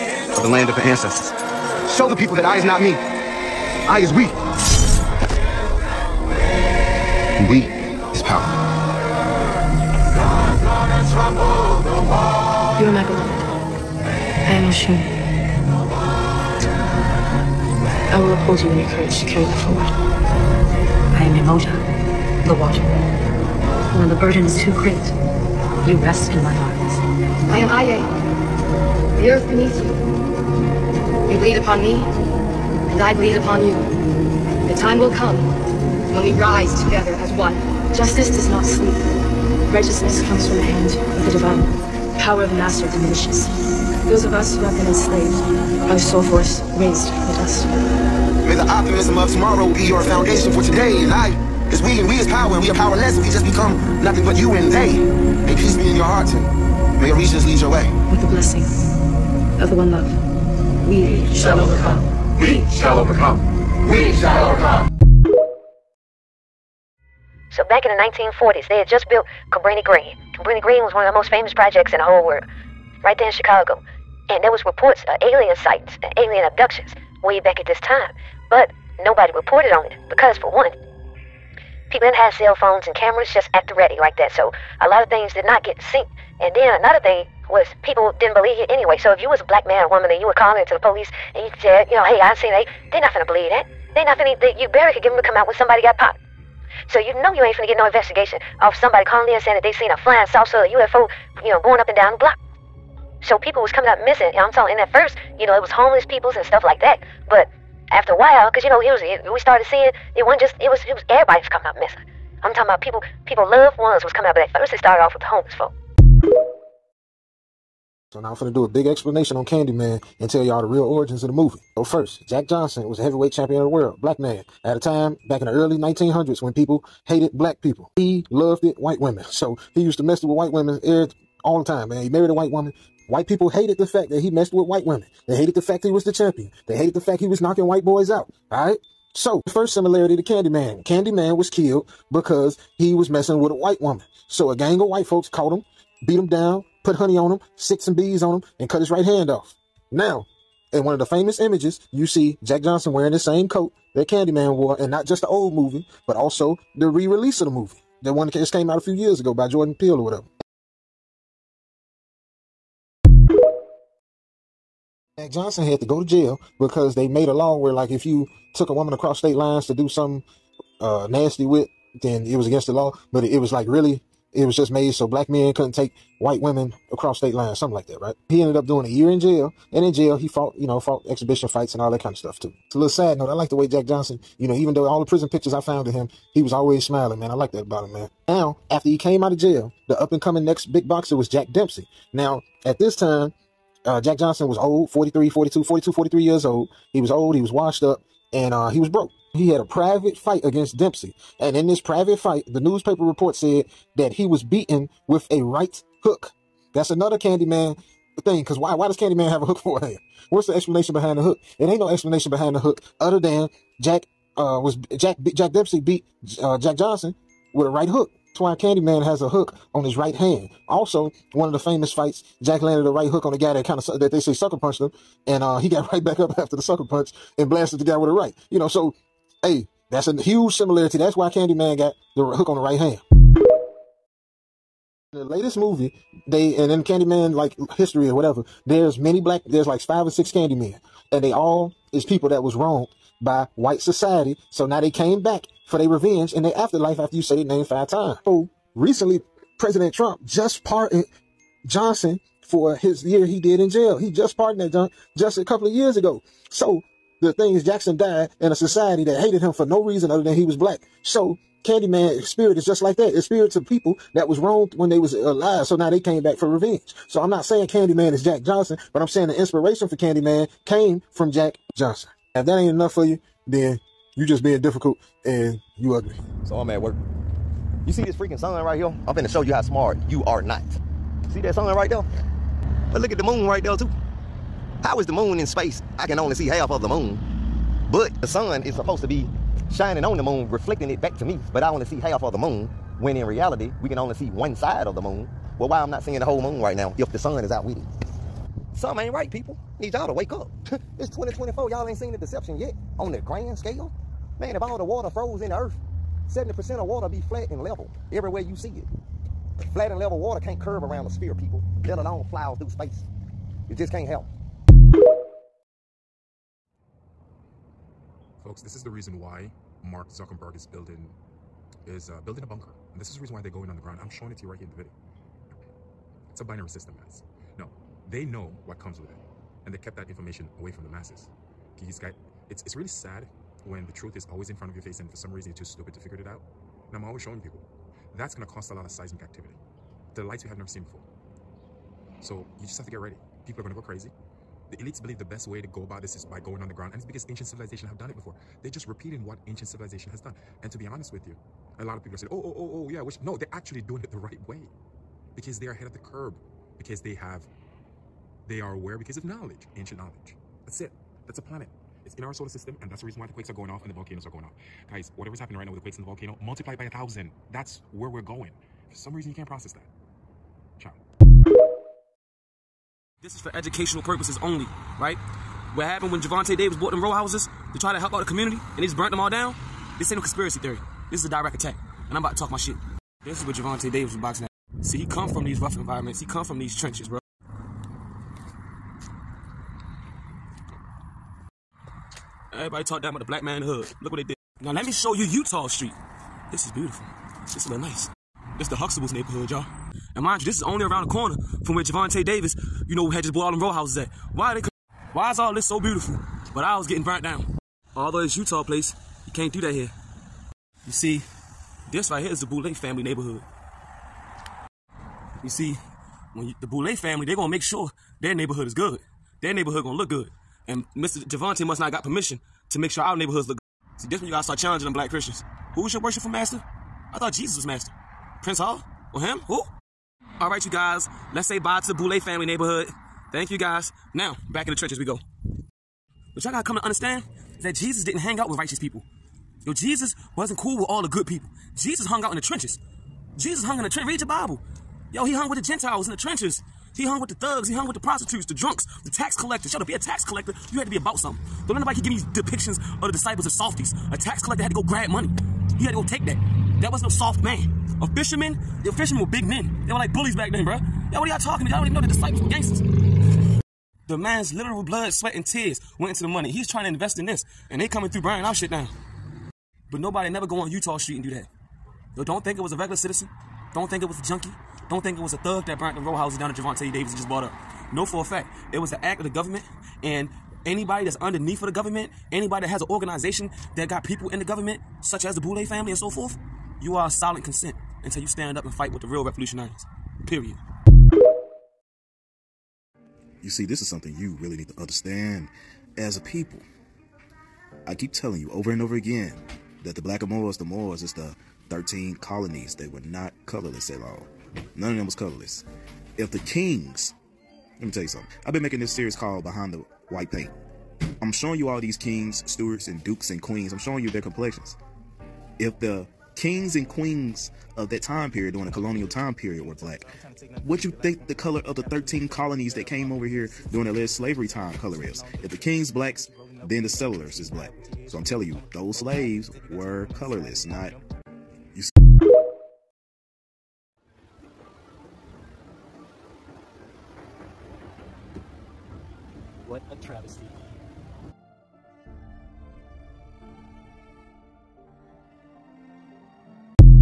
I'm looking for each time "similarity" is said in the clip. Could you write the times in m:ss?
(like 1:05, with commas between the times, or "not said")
2:19, 3:50.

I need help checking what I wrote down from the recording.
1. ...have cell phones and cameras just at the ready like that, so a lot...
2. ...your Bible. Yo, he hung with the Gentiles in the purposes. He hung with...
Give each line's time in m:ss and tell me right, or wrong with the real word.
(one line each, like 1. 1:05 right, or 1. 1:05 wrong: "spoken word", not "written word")
1. 1:22 right
2. 7:24 wrong: "trenches", not "purposes".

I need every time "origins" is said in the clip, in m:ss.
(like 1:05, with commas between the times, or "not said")
2:00.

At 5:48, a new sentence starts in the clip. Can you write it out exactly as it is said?
They're just repeating what ancient civilization has done.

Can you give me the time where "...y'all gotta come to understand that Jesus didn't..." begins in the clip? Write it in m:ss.
7:16.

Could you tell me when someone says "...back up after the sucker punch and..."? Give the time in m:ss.
3:46.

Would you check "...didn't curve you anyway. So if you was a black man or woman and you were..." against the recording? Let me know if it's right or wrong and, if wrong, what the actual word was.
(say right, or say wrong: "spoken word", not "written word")
wrong: "believe", not "curve".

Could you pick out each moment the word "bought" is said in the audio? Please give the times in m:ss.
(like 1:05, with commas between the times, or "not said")
6:16, 6:43, 7:57.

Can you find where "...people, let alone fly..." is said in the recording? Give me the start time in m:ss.
5:11.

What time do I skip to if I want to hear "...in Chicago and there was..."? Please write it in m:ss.
1:13.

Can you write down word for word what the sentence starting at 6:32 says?
Everybody talk down about the black man in the hood.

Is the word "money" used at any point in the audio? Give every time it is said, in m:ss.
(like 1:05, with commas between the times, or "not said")
7:35, 7:46.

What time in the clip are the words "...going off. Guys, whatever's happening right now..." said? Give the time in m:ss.
6:04.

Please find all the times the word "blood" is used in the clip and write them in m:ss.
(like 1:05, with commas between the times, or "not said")
7:44.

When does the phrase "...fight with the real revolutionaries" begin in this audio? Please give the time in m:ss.
8:08.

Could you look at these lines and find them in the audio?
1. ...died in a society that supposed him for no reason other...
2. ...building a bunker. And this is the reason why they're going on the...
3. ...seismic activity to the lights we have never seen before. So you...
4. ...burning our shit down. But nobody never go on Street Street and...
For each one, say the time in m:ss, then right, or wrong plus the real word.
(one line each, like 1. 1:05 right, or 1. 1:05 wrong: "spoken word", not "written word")
1. 4:17 wrong: "hated", not "supposed"
2. 5:22 right
3. 5:38 right
4. 7:48 wrong: "Utah", not "Street".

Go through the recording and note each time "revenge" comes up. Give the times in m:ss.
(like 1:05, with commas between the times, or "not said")
4:05, 4:26.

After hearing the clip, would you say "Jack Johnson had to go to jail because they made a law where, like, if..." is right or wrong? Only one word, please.
right.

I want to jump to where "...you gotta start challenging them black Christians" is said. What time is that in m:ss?
7:04.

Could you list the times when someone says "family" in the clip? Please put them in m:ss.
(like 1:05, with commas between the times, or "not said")
6:52, 6:56, 7:12, 8:05.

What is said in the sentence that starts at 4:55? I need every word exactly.
Well, why I'm not seeing the whole moon right now if the sun is out with it?